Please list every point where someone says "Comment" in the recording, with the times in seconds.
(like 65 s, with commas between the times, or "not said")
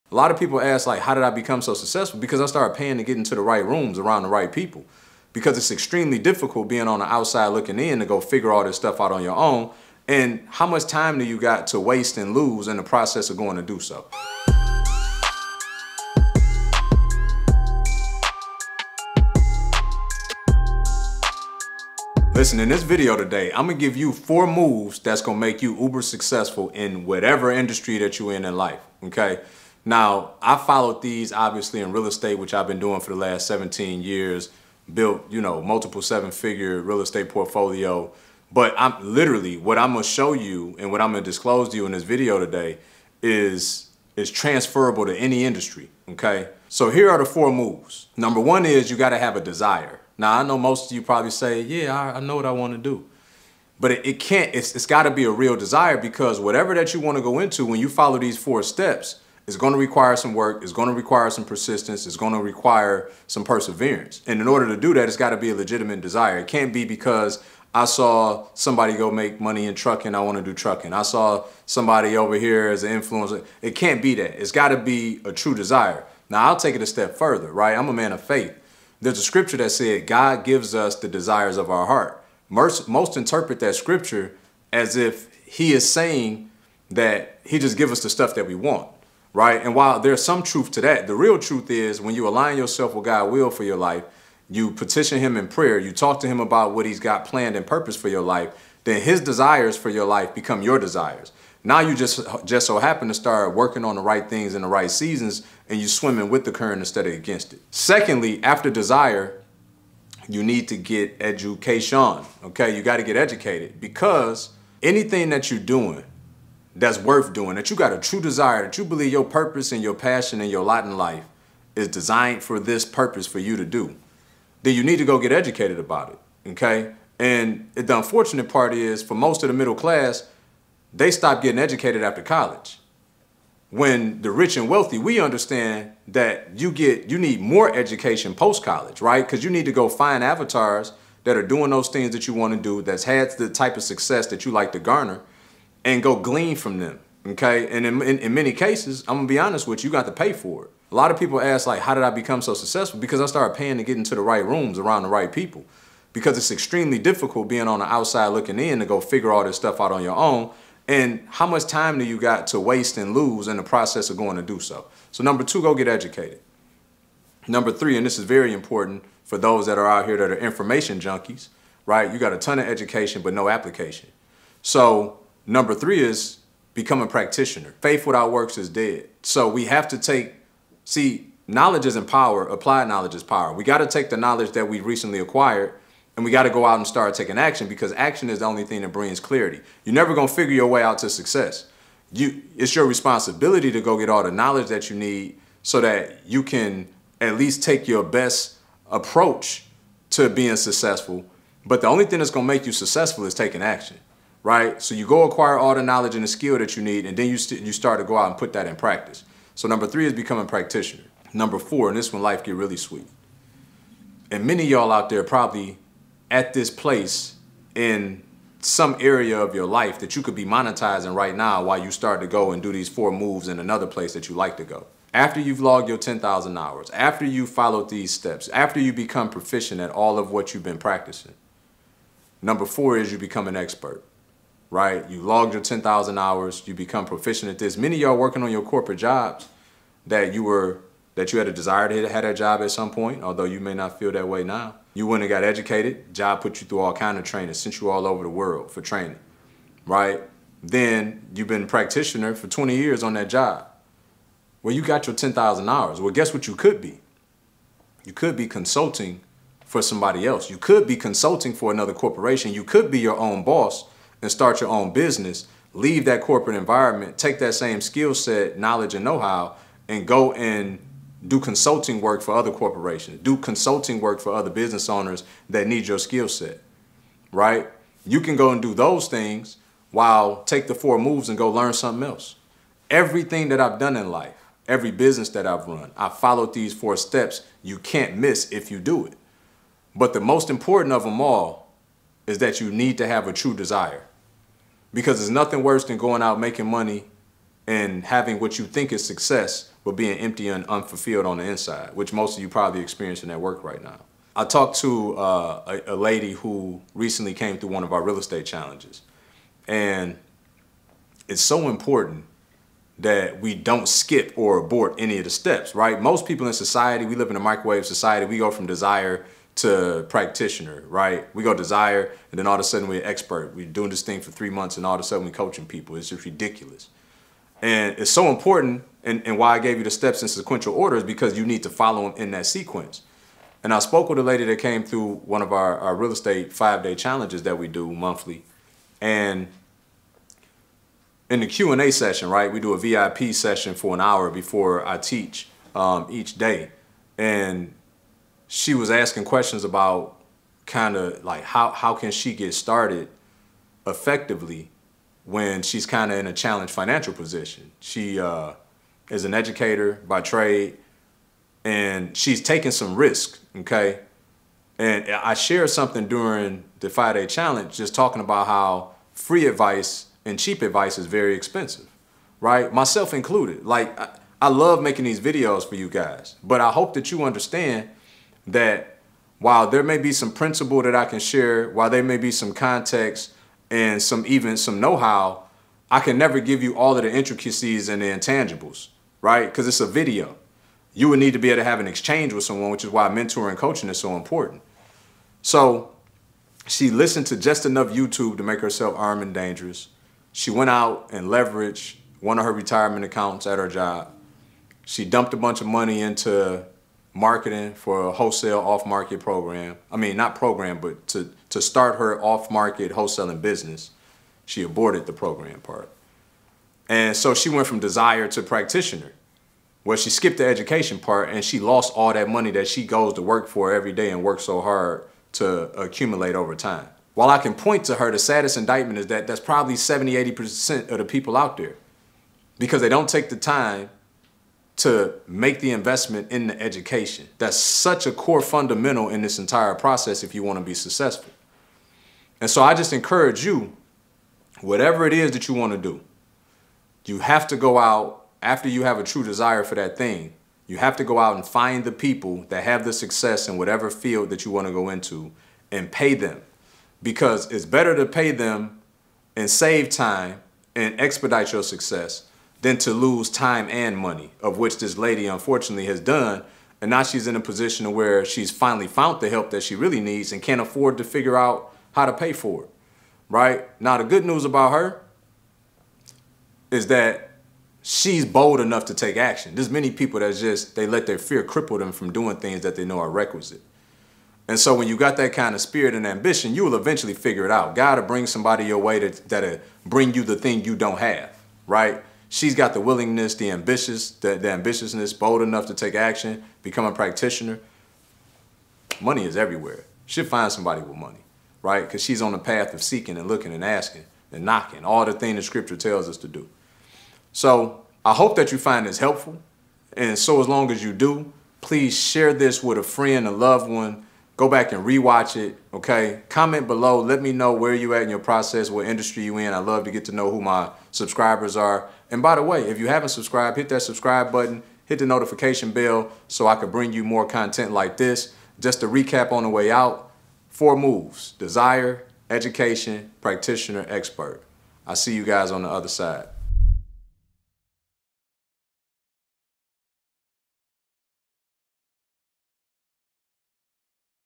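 516 s.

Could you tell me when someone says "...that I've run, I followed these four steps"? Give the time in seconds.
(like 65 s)
285 s.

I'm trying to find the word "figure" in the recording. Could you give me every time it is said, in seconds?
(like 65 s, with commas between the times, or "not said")
8 s, 36 s, 158 s, 190 s, 471 s, 487 s.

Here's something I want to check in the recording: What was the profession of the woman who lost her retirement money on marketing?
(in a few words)
educator.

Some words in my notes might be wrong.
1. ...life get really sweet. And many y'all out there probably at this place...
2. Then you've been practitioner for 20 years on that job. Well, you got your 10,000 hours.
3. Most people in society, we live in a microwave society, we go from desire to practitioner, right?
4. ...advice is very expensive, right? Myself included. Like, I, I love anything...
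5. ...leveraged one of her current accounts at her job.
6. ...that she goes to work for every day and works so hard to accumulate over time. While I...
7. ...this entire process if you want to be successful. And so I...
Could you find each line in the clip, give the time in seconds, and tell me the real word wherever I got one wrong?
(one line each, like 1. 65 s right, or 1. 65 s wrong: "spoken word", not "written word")
1. 212 s right
2. 250 s right
3. 316 s right
4. 370 s wrong: "making", not "anything"
5. 401 s wrong: "retirement", not "current"
6. 422 s right
7. 439 s right.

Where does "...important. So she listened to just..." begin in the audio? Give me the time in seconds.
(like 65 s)
394 s.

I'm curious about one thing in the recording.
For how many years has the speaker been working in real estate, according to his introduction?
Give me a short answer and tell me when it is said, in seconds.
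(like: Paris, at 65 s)
17, at 33 s.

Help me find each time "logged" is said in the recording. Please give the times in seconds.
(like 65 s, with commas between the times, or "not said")
225 s, 235 s.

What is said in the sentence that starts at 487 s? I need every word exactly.
God will bring somebody your way that, that'll bring you the thing you don't have, right?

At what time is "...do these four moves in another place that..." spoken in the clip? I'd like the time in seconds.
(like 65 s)
222 s.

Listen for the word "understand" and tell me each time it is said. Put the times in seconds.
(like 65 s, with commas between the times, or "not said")
135 s, 377 s.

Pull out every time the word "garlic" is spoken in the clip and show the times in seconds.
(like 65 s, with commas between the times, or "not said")
not said.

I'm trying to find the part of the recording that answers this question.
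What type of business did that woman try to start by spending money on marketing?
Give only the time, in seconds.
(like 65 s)
412 s.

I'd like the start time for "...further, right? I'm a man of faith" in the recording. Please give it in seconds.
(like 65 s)
77 s.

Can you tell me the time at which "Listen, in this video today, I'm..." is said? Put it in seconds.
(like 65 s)
22 s.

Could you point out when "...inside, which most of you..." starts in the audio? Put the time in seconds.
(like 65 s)
301 s.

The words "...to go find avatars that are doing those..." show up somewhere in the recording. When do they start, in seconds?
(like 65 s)
139 s.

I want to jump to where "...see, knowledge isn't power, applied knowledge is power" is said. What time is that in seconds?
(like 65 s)
180 s.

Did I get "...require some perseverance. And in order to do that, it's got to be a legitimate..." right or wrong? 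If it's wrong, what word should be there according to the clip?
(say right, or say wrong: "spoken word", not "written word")
right.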